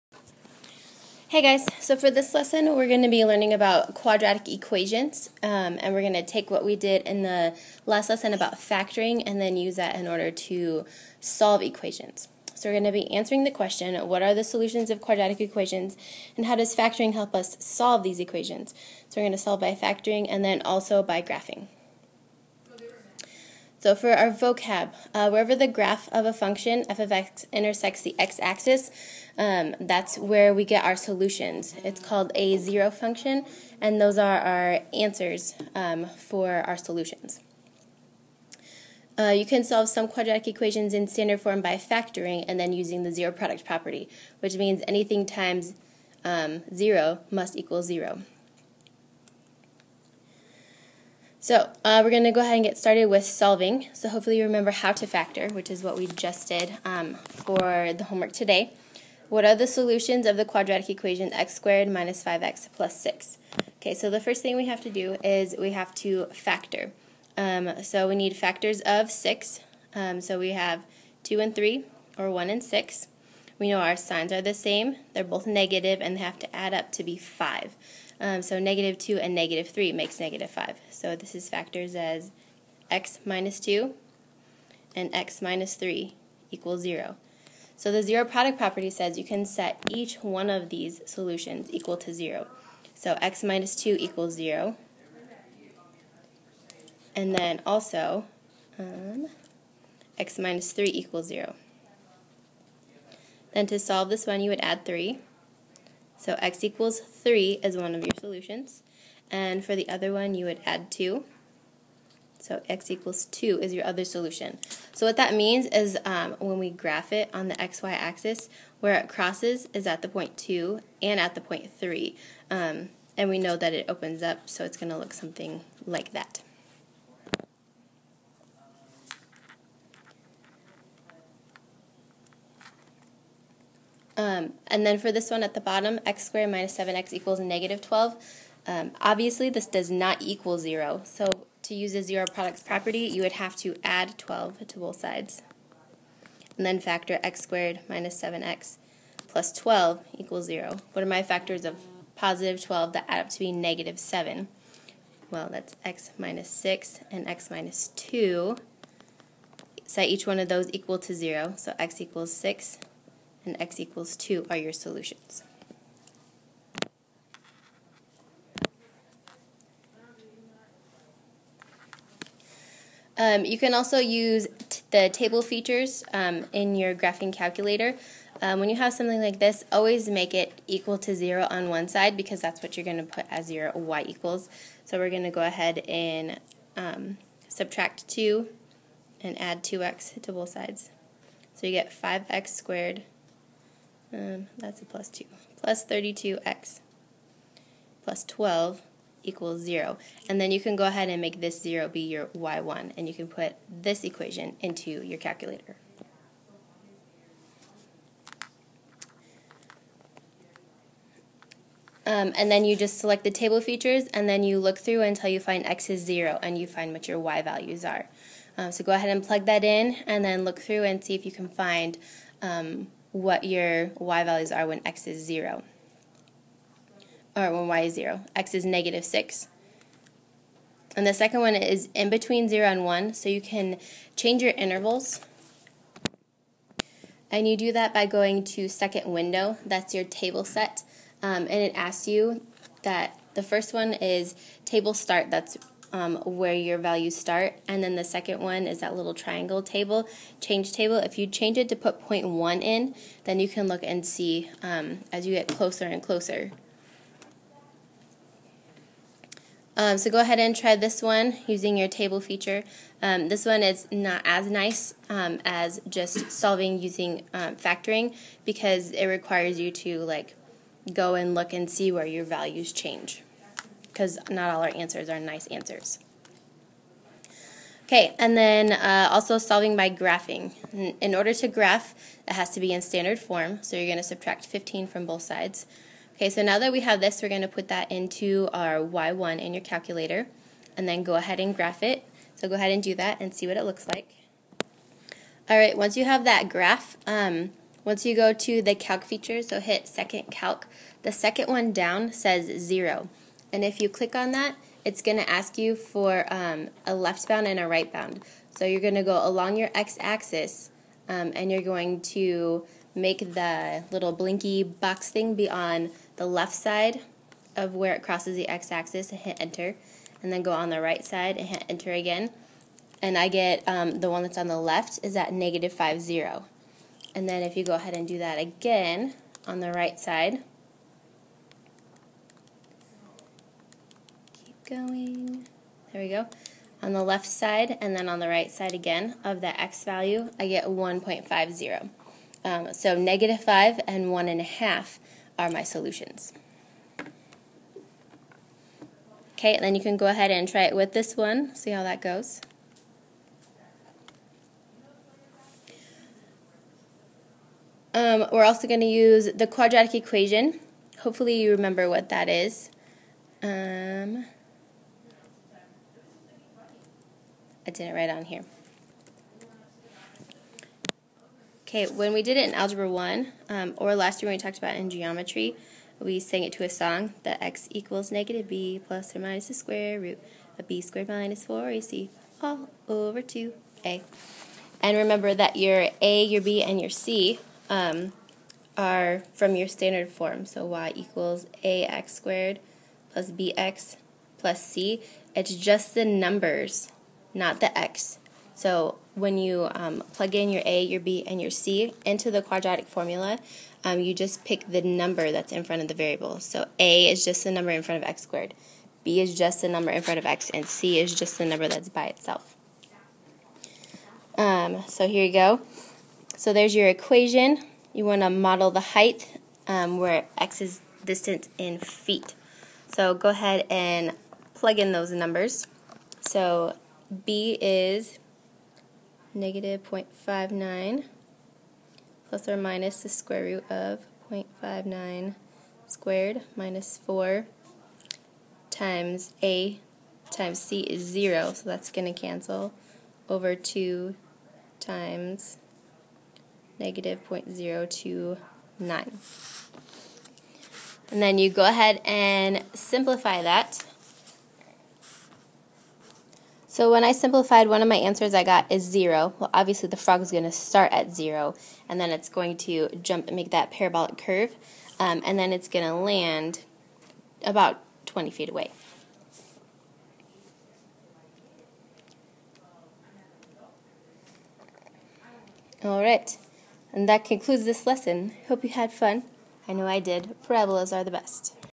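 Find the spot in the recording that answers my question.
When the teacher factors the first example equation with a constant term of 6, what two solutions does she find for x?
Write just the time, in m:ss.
1:46.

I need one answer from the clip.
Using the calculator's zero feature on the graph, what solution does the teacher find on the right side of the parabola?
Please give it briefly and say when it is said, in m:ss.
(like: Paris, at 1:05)
1.5, at 5:40.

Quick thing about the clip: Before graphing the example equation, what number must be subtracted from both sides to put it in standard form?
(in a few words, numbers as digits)
15.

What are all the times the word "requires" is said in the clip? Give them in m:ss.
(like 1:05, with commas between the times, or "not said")
4:29.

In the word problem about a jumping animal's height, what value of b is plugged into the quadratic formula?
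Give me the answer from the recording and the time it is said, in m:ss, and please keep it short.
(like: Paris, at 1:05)
-0.59, at 7:09.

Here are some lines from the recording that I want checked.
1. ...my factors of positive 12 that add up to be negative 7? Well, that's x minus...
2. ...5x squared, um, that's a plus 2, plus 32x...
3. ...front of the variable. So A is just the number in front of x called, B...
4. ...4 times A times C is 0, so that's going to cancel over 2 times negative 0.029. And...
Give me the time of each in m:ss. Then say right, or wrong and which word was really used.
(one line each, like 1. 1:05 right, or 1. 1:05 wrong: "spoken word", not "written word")
1. 2:31 right
2. 3:11 right
3. 6:45 wrong: "squared", not "called"
4. 7:16 right.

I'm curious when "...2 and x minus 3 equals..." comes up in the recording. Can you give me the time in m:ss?
1:23.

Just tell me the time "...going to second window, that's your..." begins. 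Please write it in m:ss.
3:58.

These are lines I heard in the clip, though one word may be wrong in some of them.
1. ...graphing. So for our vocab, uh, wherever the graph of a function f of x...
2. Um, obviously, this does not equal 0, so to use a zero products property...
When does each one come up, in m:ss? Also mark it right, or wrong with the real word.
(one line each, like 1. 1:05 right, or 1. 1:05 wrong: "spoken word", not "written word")
1. 0:21 right
2. 2:18 right.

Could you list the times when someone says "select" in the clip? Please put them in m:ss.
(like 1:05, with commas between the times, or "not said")
3:32.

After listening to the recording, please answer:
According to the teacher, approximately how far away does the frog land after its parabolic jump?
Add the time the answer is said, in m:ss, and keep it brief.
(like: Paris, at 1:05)
20 feet, at 7:48.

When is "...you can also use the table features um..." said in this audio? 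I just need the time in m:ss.
2:53.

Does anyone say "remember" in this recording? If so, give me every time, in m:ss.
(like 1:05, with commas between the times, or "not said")
0:54, 6:01, 6:24.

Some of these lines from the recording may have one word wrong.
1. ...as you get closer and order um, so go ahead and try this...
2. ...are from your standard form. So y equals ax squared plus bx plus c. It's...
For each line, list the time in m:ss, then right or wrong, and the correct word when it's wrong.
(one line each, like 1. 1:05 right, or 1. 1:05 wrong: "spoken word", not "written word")
1. 4:15 wrong: "closer", not "order"
2. 6:28 right.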